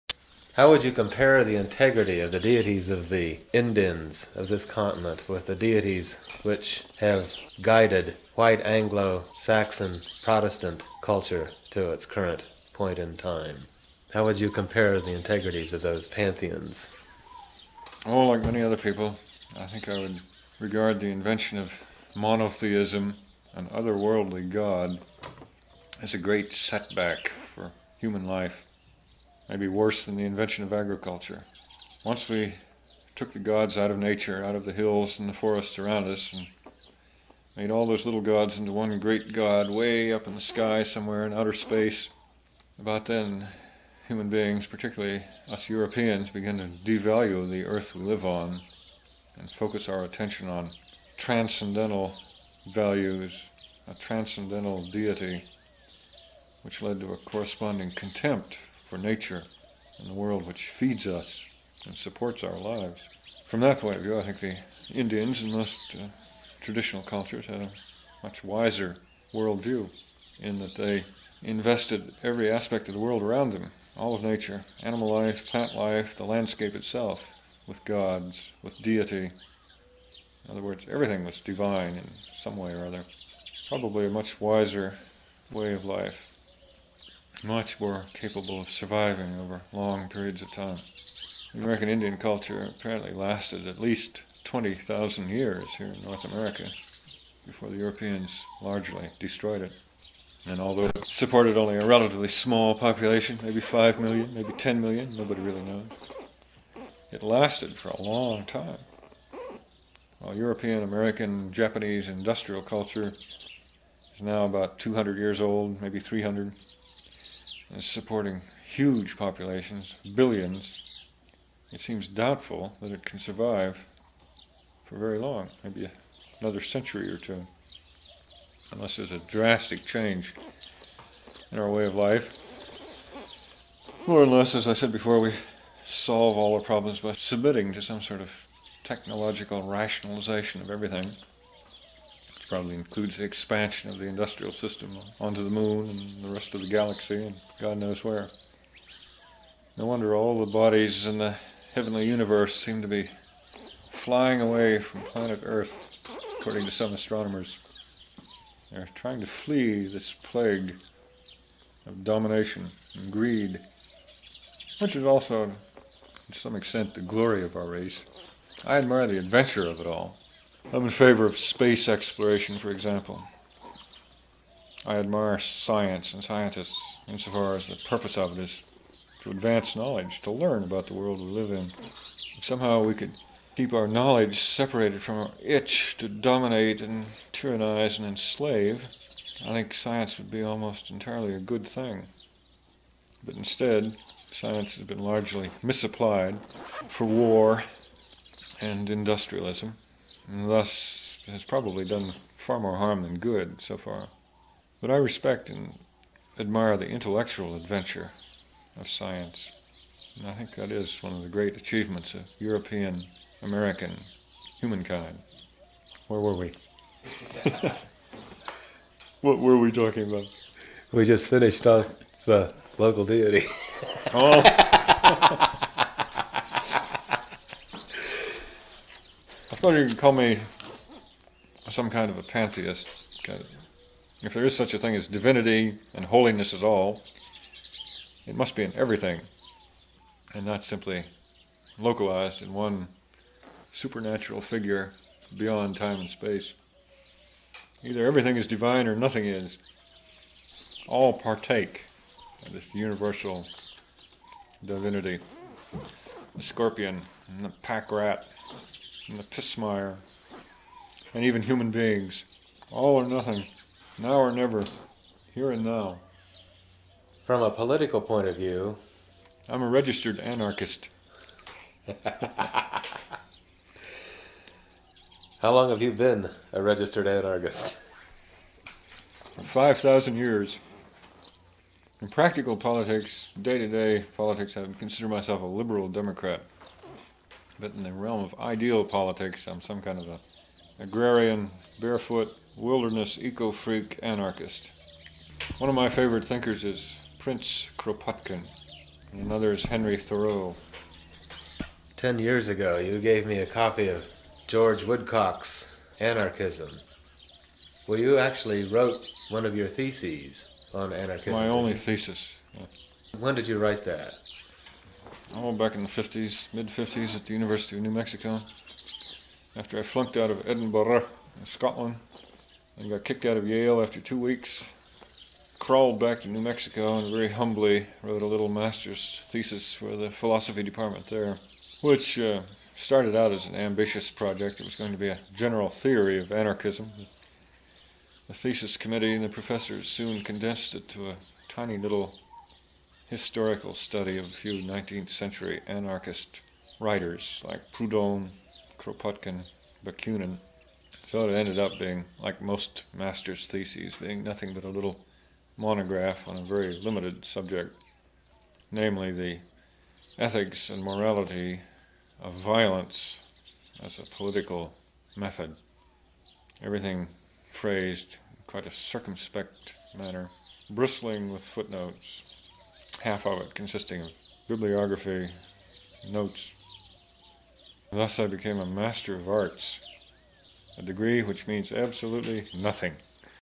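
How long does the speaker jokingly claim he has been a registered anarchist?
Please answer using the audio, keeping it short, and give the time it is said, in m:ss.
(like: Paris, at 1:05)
5,000 years, at 4:39.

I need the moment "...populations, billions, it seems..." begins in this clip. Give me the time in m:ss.
1:59.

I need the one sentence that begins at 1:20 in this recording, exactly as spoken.
In other words, everything was divine in some way or other.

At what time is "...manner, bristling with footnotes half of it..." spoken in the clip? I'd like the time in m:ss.
6:09.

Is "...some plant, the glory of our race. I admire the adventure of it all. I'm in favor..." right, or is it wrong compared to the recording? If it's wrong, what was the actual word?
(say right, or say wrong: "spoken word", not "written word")
wrong: "extent", not "plant".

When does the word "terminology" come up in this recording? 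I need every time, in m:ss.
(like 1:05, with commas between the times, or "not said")
not said.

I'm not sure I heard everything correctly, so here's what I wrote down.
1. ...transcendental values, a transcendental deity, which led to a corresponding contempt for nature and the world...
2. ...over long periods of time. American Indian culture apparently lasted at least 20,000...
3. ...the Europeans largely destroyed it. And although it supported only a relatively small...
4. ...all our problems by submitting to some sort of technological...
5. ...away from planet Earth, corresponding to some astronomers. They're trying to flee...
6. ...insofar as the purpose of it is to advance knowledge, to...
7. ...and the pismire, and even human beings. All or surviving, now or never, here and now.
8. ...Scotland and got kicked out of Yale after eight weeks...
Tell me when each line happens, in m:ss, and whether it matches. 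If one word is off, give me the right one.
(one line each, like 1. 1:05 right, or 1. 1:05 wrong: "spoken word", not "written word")
1. 0:51 right
2. 1:29 right
3. 1:37 right
4. 2:16 right
5. 2:34 wrong: "according", not "corresponding"
6. 2:57 right
7. 4:19 wrong: "nothing", not "surviving"
8. 5:21 wrong: "two", not "eight".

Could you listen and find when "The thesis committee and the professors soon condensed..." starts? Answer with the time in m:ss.
5:38.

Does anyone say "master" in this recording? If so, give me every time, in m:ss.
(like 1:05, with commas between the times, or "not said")
5:28, 5:52, 6:18.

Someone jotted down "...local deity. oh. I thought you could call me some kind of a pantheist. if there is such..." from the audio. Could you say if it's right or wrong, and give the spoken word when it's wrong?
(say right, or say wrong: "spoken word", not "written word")
right.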